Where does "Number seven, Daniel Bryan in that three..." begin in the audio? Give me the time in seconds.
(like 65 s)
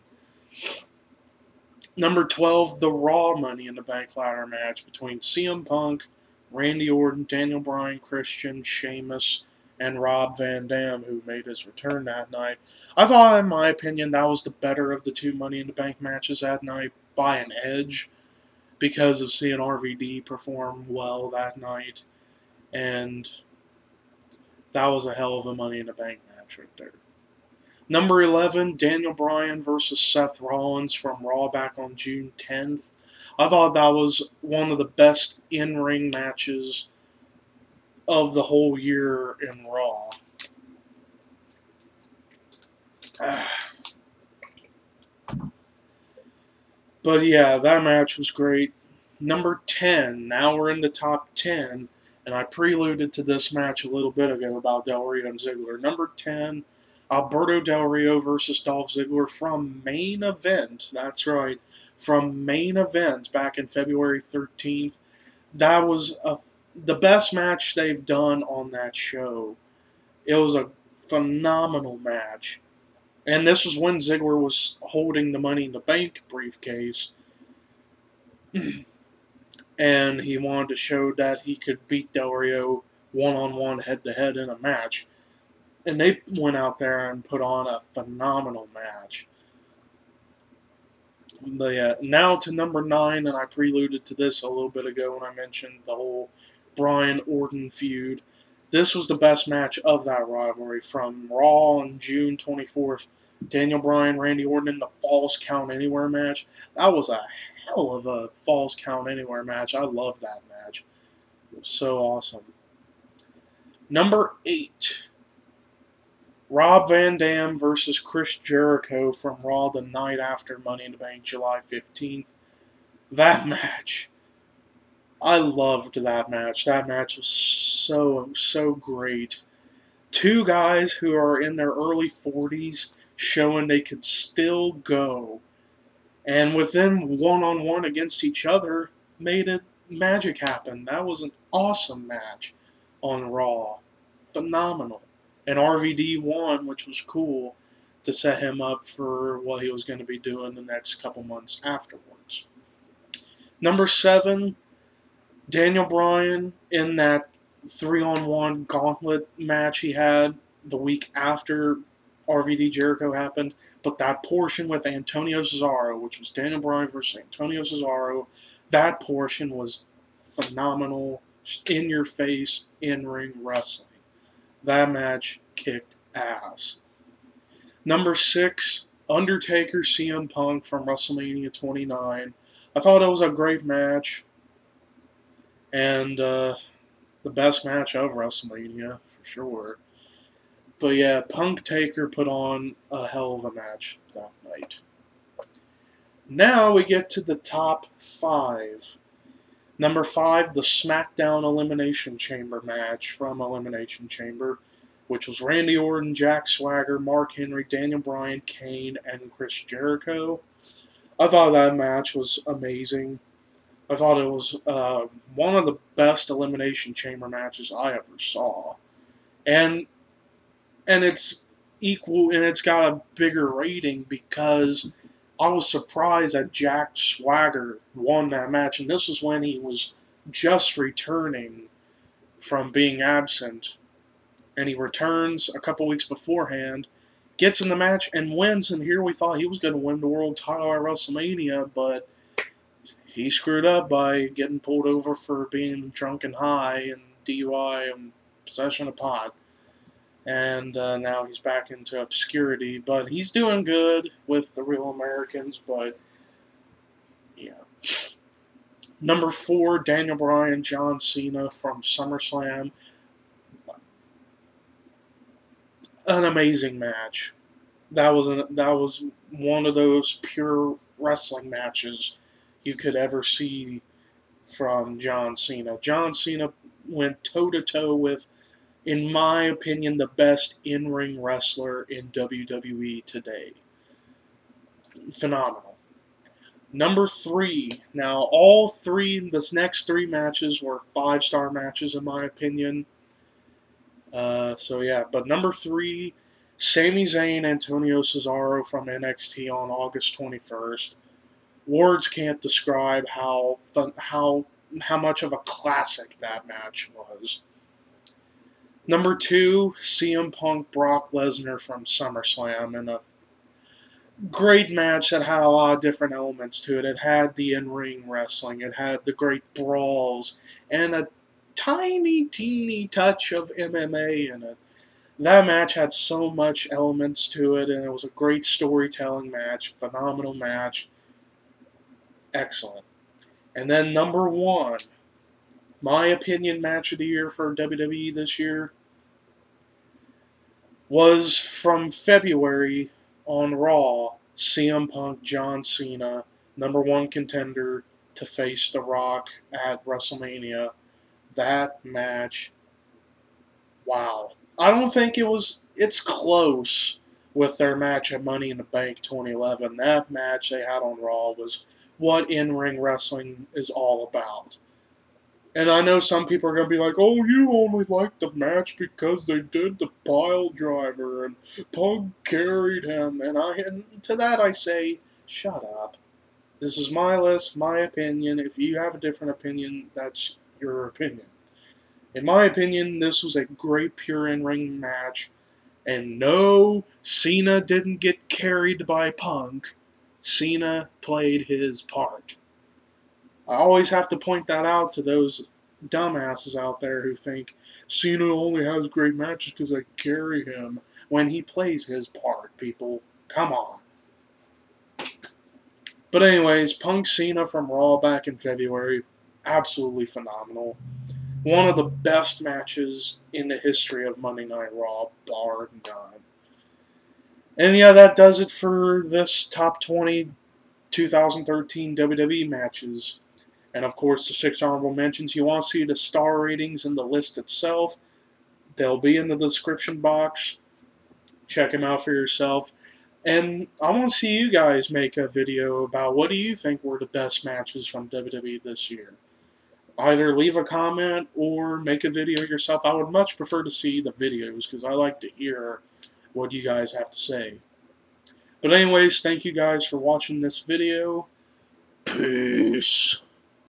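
153 s.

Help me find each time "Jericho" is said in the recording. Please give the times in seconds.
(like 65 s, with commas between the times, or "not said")
118 s, 162 s, 209 s.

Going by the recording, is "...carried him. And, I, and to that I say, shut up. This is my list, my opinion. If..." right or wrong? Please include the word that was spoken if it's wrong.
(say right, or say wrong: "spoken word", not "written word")
right.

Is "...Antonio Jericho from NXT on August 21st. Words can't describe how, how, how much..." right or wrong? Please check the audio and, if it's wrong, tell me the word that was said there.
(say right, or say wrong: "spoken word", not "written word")
wrong: "Cesaro", not "Jericho".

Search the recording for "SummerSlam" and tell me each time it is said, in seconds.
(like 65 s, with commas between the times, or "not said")
261 s, 311 s.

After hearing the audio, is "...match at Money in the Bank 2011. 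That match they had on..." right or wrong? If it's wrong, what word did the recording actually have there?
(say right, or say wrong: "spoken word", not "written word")
right.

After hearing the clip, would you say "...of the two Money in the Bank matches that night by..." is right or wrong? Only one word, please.
right.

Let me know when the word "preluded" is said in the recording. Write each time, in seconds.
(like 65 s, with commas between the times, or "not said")
52 s, 93 s.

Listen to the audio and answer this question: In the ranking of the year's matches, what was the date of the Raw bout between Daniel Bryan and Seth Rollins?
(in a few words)
June 10th.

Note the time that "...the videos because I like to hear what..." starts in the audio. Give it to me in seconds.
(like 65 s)
443 s.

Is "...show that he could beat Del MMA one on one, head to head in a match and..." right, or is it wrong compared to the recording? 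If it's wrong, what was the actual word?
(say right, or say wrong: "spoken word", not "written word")
wrong: "Rio", not "MMA".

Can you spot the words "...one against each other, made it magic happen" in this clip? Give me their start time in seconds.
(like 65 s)
137 s.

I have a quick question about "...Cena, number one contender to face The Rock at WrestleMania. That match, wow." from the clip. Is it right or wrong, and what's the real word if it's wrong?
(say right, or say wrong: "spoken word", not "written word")
right.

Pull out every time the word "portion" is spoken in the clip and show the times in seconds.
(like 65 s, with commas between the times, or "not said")
164 s, 169 s.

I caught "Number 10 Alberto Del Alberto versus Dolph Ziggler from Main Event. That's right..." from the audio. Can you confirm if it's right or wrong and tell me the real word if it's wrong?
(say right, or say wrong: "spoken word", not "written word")
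wrong: "Rio", not "Alberto".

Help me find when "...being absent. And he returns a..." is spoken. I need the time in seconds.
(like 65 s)
232 s.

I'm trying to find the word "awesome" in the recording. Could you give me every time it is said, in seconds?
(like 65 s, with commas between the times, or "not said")
111 s, 141 s.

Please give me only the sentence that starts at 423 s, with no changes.
And of course, the six honorable mentions.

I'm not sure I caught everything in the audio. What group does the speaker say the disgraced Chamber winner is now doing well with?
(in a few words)
The Real Americans.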